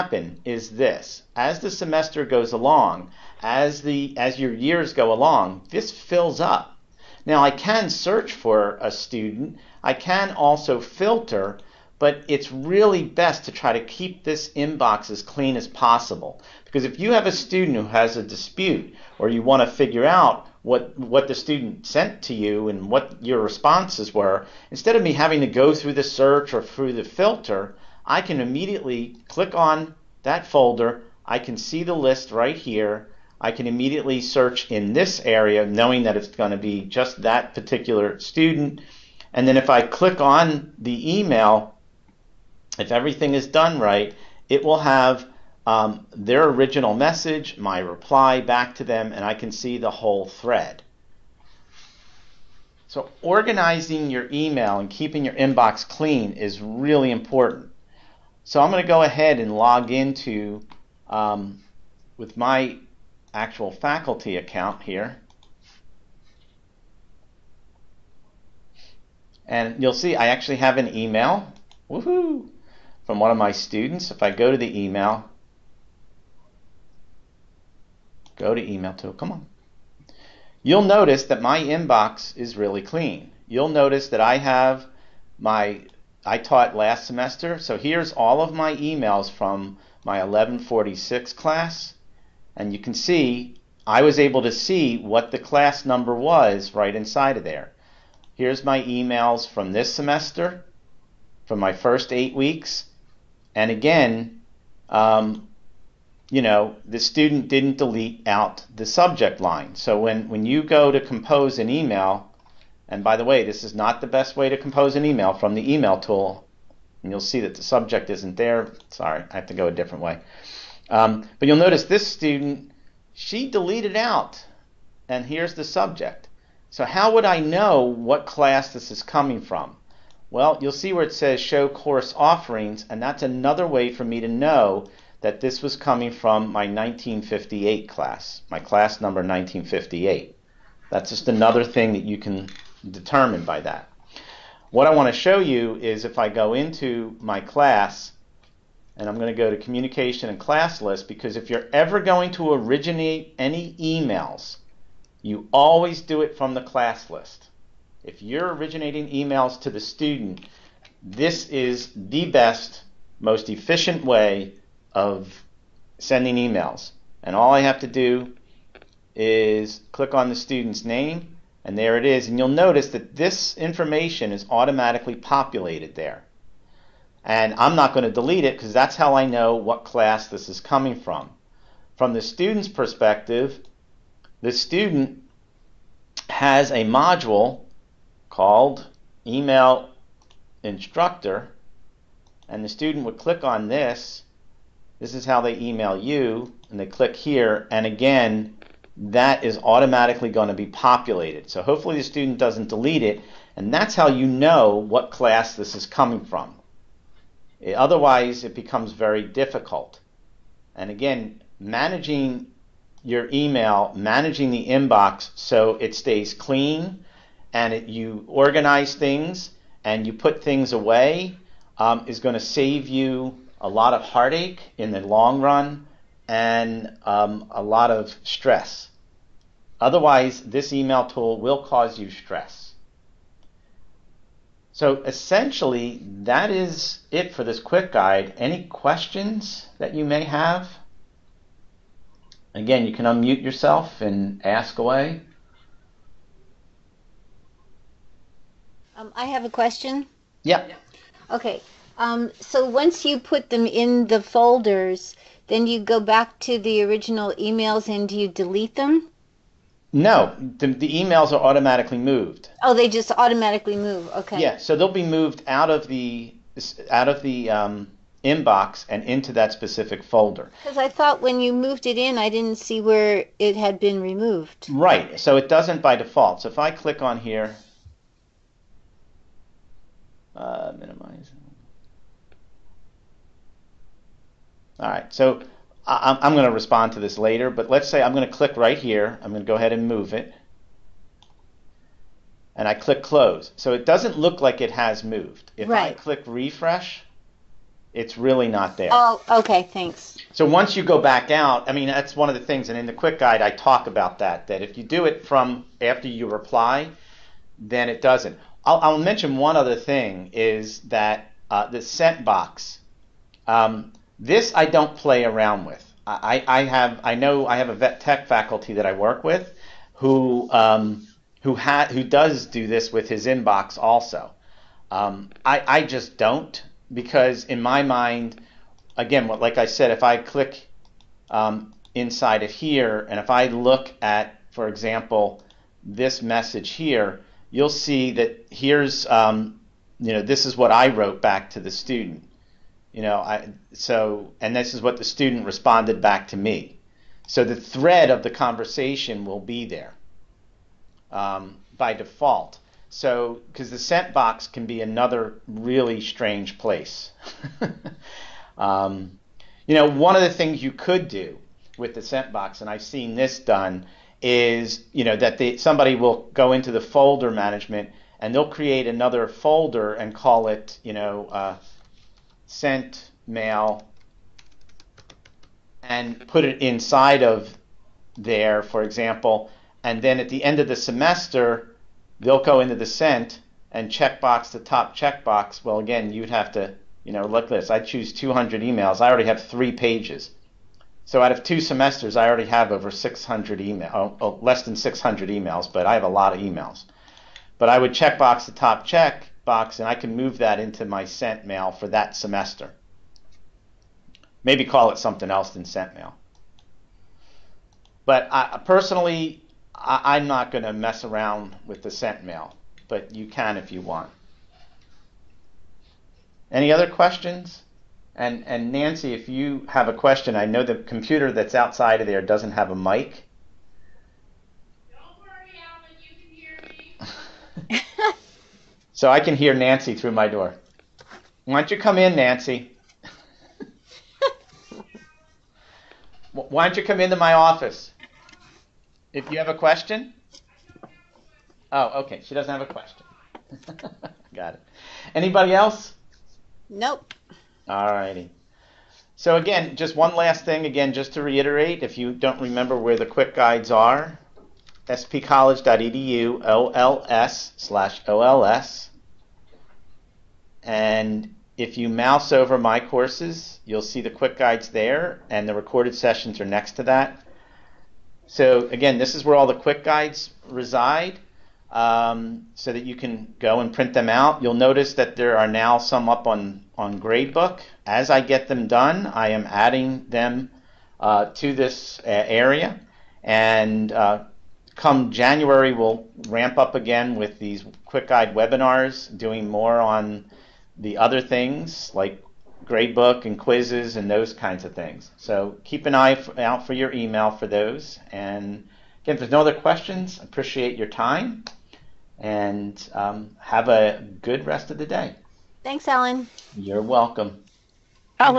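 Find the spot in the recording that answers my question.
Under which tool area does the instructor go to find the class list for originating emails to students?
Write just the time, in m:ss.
2:29.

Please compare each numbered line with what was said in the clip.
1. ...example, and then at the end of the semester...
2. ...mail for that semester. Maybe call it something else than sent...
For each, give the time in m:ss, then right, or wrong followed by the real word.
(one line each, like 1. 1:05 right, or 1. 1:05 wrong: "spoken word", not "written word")
1. 6:18 right
2. 6:41 right.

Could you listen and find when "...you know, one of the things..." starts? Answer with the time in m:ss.
5:59.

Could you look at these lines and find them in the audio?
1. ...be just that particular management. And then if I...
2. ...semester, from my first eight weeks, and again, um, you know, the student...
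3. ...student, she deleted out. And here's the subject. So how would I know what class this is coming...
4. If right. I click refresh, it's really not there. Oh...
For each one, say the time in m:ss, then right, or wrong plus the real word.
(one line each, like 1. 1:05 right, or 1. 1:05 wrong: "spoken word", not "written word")
1. 0:36 wrong: "student", not "management"
2. 1:39 right
3. 2:02 right
4. 4:55 right.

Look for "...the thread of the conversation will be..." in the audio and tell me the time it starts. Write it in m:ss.
5:47.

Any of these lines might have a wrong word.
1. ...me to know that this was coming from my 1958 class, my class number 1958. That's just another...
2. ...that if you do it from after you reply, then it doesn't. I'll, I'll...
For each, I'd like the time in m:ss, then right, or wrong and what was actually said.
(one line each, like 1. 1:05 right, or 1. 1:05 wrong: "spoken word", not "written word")
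1. 2:14 right
2. 5:04 right.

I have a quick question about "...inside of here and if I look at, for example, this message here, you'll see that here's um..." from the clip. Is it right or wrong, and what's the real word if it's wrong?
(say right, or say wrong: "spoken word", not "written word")
right.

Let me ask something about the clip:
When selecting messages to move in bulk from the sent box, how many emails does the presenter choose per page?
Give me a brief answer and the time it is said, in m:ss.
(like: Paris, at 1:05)
200, at 6:28.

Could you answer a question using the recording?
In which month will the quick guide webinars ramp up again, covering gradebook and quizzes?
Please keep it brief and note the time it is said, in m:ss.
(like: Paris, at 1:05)
January, at 8:05.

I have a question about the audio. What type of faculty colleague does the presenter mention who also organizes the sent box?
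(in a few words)
vet tech.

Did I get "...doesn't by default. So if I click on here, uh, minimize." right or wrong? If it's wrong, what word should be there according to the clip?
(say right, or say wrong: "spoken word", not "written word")
right.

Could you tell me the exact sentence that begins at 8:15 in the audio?
So keep an eye out for your email for those.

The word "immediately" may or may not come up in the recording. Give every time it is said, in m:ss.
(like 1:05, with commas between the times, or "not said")
0:28, 0:33.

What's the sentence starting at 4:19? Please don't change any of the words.
No, the, the, emails are automatically moved.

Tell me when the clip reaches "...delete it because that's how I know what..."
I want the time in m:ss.
2:58.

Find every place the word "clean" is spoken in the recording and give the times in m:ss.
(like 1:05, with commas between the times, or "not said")
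0:15, 0:55, 1:22, 3:36.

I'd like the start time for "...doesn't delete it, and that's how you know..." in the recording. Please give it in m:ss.
3:22.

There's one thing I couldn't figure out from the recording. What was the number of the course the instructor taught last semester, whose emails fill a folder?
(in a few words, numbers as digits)
1146.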